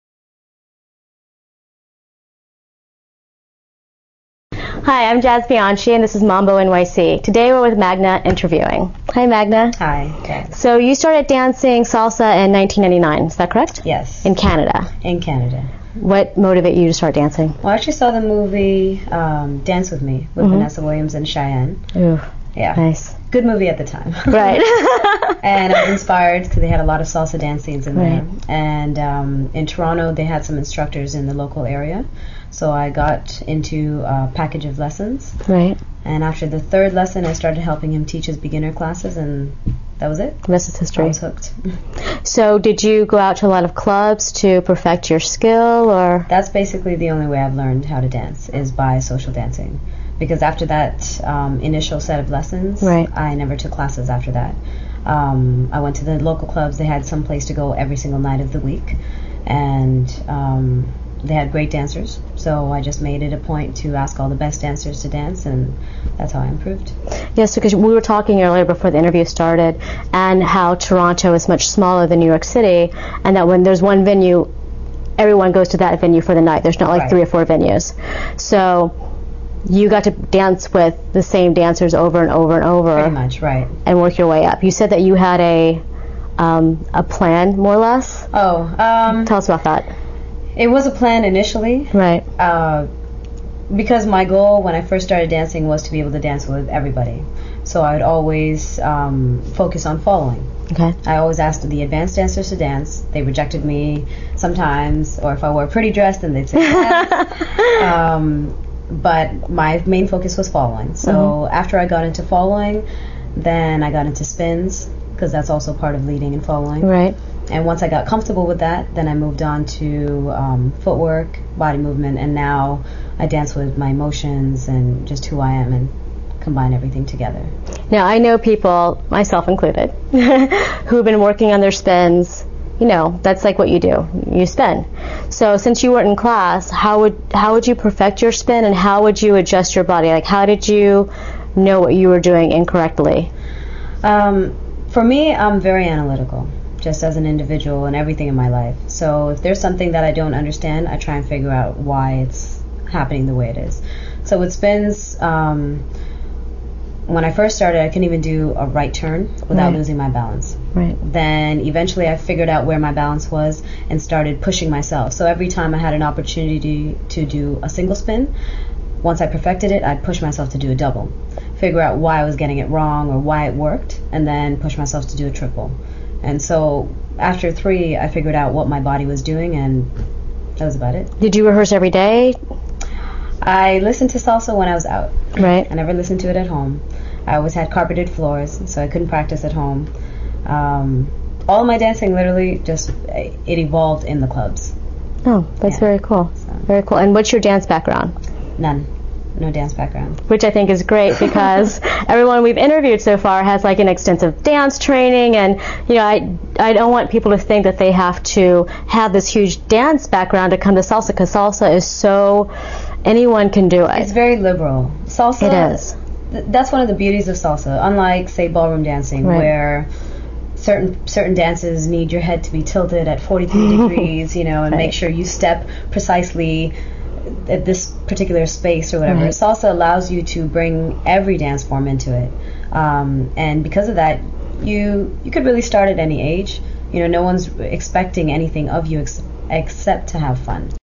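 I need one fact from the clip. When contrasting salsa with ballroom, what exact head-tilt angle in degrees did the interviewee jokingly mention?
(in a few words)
43.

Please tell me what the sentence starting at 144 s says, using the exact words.
Um, for me, I'm very analytical, just as an individual and everything in my life.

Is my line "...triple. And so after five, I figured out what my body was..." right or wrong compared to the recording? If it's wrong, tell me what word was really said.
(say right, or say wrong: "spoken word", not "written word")
wrong: "three", not "five".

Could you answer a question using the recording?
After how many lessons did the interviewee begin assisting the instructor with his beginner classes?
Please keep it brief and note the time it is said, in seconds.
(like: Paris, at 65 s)
3, at 36 s.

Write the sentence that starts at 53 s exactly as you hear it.
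I never took classes after that.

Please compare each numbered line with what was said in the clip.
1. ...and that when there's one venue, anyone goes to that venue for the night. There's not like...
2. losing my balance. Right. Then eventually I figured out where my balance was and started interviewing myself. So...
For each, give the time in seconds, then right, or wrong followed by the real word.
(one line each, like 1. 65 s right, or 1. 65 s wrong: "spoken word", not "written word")
1. 73 s wrong: "everyone", not "anyone"
2. 159 s wrong: "pushing", not "interviewing".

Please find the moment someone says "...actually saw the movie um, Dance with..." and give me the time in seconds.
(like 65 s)
17 s.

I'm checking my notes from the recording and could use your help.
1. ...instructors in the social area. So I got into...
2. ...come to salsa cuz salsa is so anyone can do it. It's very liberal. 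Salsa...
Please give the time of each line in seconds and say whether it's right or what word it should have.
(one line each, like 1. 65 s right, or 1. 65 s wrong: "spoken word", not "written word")
1. 30 s wrong: "local", not "social"
2. 210 s right.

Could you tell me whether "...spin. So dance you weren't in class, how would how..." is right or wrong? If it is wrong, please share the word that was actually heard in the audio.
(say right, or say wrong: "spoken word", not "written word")
wrong: "since", not "dance".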